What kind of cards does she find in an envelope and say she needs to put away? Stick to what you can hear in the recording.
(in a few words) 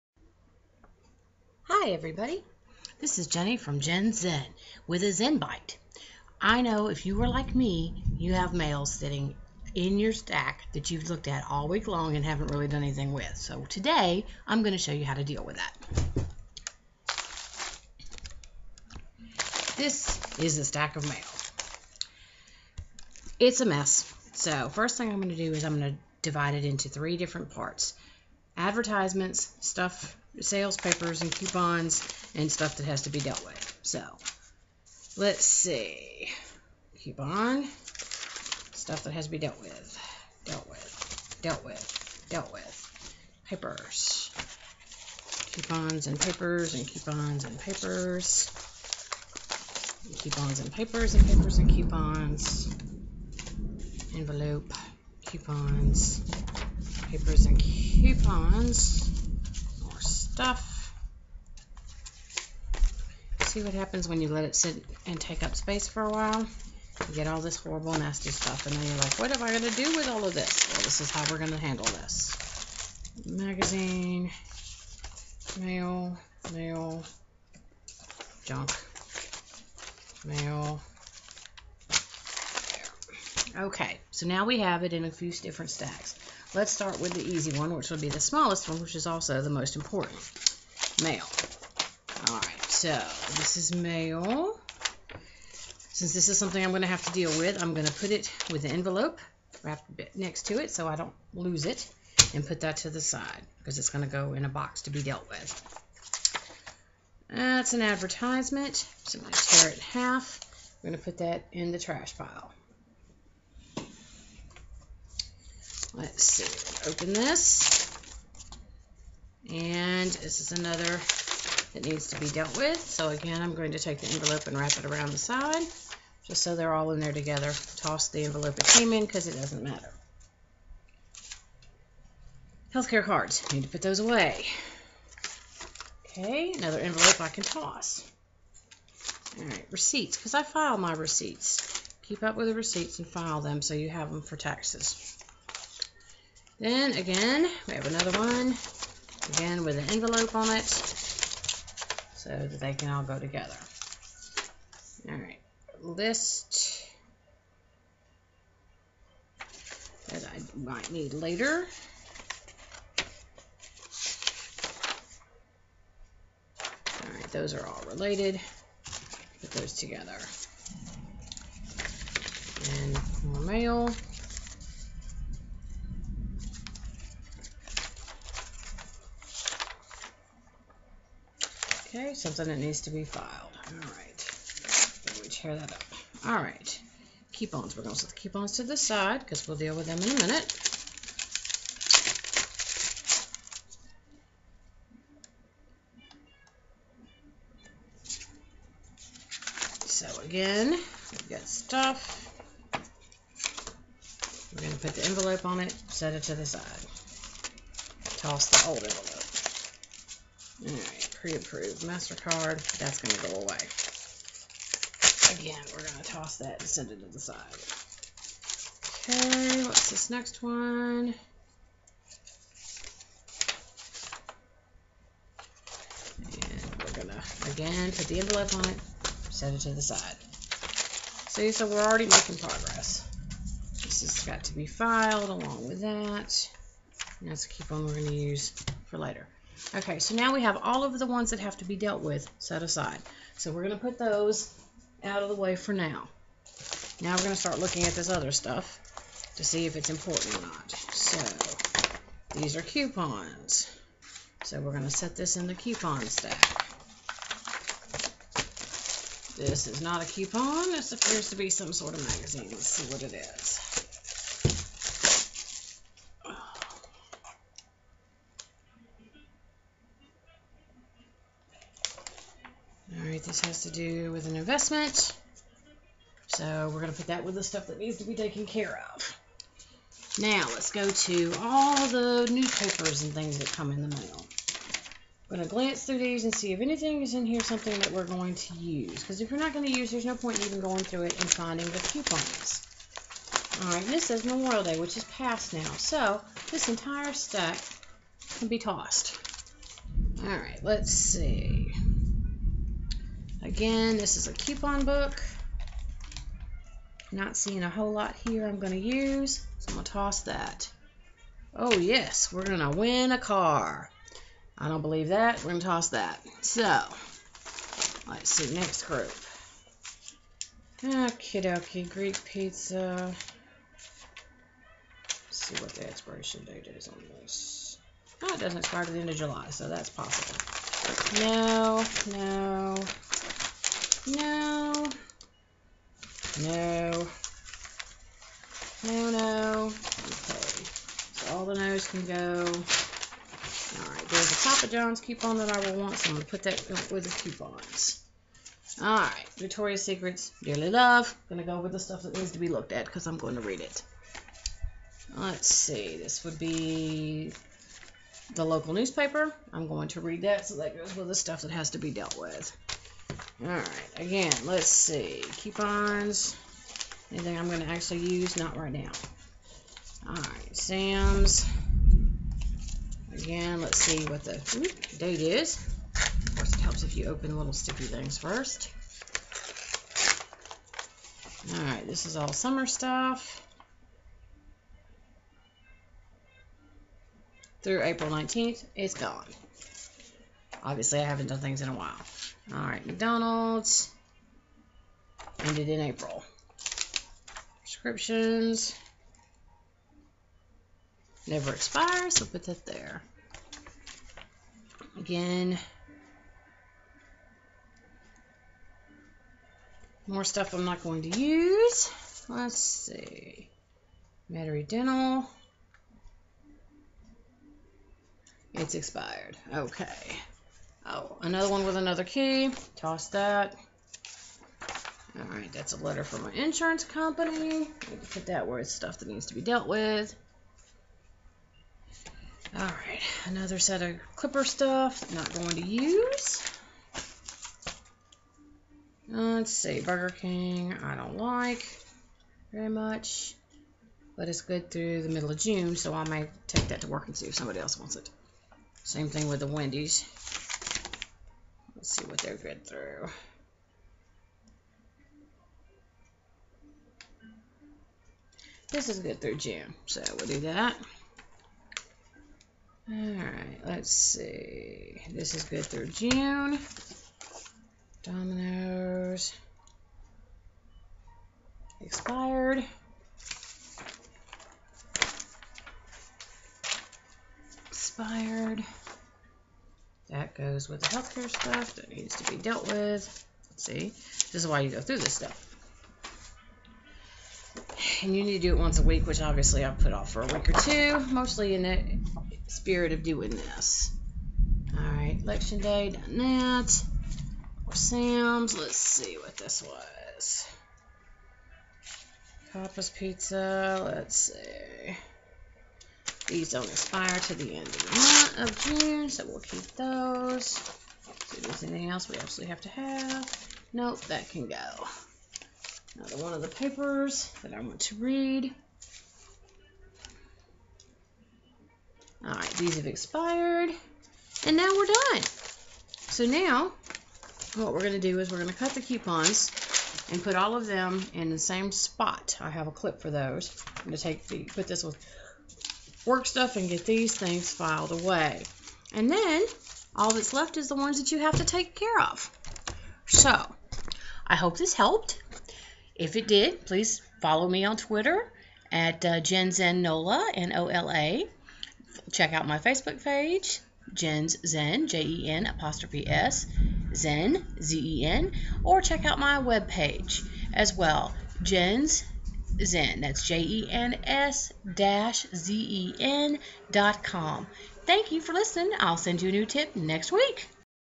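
Healthcare cards.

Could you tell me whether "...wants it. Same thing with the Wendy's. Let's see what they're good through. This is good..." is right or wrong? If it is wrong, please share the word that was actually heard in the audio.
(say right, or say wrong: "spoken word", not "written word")
right.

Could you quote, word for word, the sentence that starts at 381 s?
Alright, this is all summer stuff.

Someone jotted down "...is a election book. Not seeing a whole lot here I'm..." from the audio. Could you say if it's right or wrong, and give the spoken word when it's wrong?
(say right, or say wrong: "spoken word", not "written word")
wrong: "coupon", not "election".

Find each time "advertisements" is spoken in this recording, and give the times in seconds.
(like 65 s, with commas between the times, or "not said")
28 s, 107 s.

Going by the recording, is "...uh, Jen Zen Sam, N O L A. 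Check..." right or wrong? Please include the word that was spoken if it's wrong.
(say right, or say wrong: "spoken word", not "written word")
wrong: "Nola", not "Sam".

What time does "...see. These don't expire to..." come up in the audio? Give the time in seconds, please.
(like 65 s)
504 s.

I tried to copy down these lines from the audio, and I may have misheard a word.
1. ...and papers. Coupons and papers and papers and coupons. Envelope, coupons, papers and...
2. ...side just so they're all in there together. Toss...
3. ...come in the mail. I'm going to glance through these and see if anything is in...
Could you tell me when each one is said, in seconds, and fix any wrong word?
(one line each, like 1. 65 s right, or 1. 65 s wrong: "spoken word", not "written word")
1. 47 s right
2. 125 s right
3. 283 s right.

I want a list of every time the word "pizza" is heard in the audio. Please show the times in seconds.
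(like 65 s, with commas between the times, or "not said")
322 s, 502 s.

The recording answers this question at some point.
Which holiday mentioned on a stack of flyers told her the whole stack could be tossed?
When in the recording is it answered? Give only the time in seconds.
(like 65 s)
294 s.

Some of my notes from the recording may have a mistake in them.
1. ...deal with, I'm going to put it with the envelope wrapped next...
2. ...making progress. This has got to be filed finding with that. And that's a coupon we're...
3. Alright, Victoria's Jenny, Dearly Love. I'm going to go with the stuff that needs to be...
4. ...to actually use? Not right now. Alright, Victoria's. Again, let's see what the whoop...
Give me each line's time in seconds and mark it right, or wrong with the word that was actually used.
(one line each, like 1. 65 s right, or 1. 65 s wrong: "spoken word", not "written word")
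1. 97 s right
2. 232 s wrong: "along", not "finding"
3. 348 s wrong: "Secrets", not "Jenny"
4. 367 s wrong: "Sam", not "Victoria".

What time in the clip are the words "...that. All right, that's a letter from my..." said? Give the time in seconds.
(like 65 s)
423 s.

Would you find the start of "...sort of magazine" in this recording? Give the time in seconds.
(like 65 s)
261 s.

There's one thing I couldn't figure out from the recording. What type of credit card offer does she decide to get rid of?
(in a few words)
Pre-approved MasterCard.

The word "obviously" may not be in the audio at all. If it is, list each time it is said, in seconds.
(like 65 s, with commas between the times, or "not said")
390 s, 489 s.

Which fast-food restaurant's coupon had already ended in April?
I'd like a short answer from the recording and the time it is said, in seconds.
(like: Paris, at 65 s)
McDonald's, at 392 s.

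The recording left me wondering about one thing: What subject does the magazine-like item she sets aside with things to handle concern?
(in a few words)
An investment.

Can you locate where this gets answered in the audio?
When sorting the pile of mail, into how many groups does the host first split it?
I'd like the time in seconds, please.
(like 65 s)
26 s.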